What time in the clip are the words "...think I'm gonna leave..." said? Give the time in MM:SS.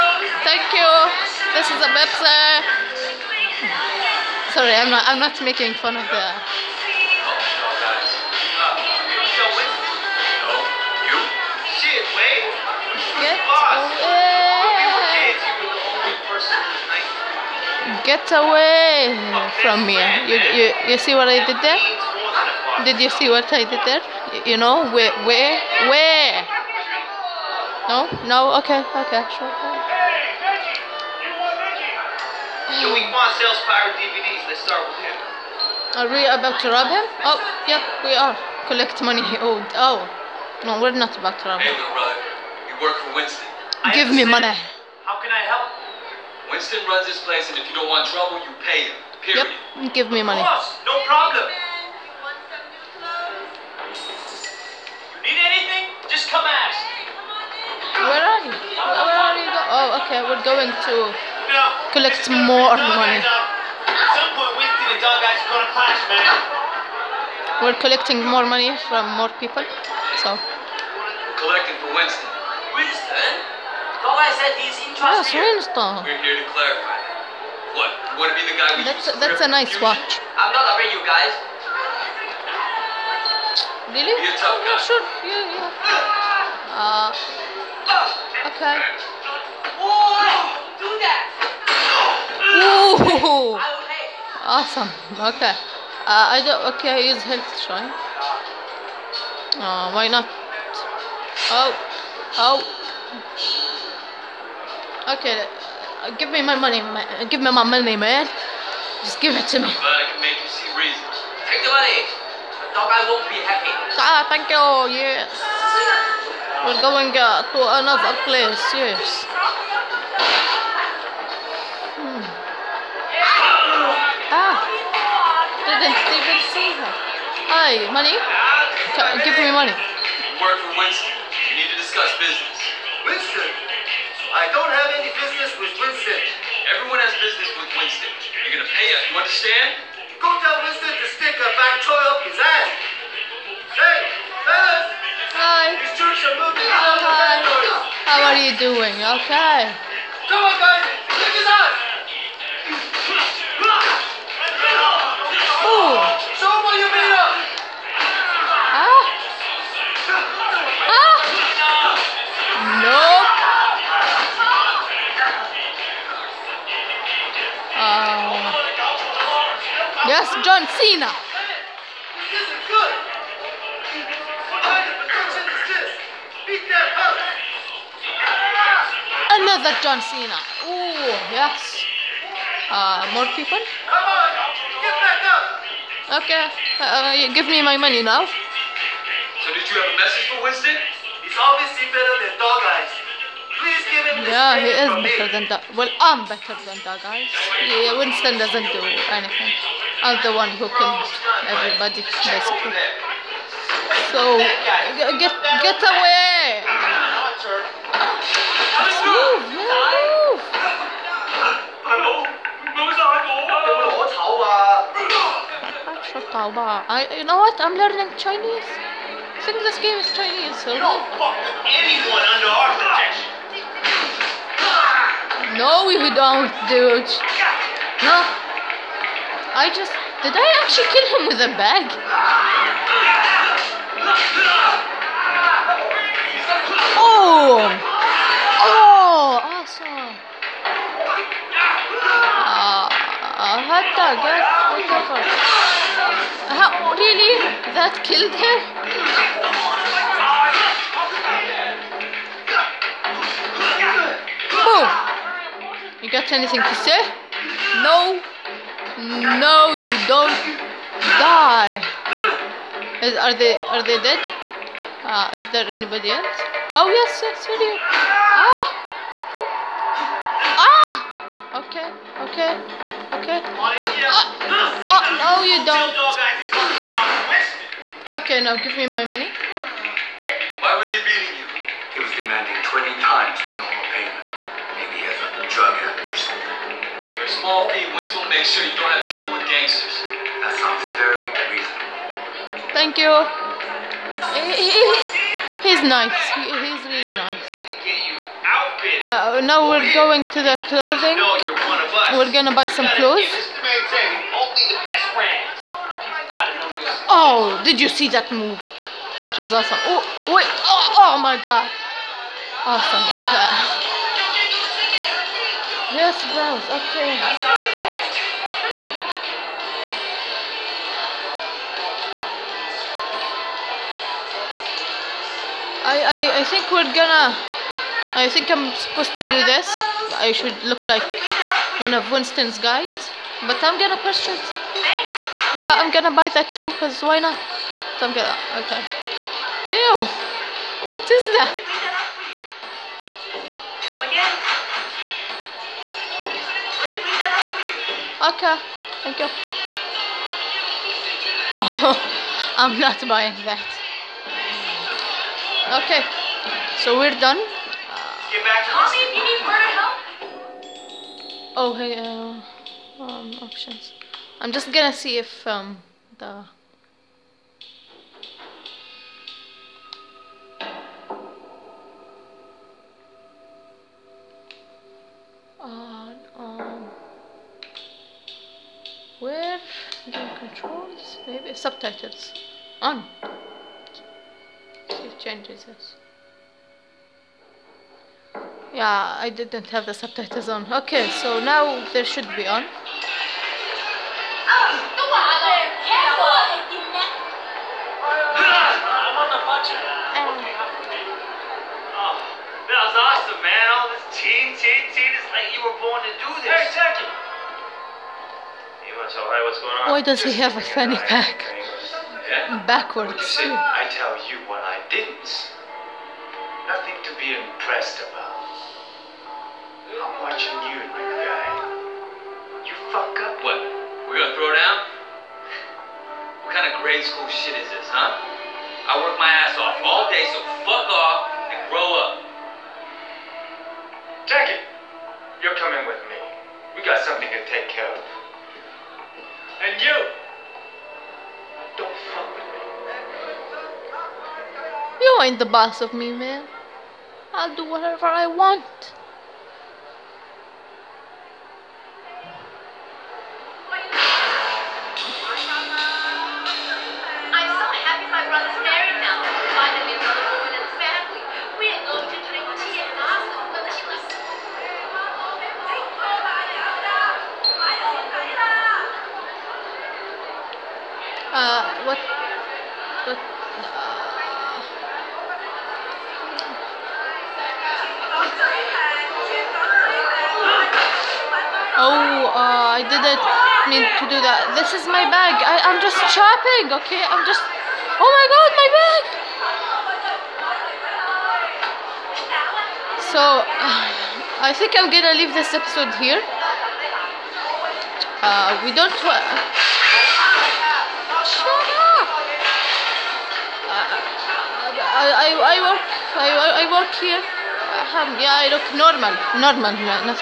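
08:14.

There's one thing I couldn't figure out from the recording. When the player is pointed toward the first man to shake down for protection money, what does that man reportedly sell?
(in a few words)
pirate DVDs.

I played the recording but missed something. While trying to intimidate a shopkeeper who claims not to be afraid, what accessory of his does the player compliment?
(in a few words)
watch.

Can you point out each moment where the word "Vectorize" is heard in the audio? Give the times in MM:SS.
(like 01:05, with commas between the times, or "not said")
not said.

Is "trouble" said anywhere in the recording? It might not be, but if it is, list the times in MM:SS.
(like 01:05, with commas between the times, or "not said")
00:48, 04:49.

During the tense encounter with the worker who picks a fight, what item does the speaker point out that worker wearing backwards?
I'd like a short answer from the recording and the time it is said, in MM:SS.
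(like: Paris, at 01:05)
fanny pack, at 06:50.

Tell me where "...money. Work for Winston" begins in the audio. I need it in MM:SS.
02:09.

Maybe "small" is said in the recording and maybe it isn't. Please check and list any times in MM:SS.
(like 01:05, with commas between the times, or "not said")
04:47.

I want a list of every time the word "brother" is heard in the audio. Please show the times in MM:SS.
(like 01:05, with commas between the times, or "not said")
00:41.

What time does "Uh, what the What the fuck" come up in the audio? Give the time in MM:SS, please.
04:02.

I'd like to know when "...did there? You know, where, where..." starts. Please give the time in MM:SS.
00:23.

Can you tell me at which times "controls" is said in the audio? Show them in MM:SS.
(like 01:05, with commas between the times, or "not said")
06:20.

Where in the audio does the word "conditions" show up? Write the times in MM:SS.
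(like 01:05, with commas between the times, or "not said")
not said.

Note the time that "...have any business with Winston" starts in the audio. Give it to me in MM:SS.
02:14.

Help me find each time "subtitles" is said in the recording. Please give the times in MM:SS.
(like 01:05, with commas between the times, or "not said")
06:21, 06:29.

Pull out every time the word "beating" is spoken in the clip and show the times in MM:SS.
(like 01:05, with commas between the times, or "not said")
04:41.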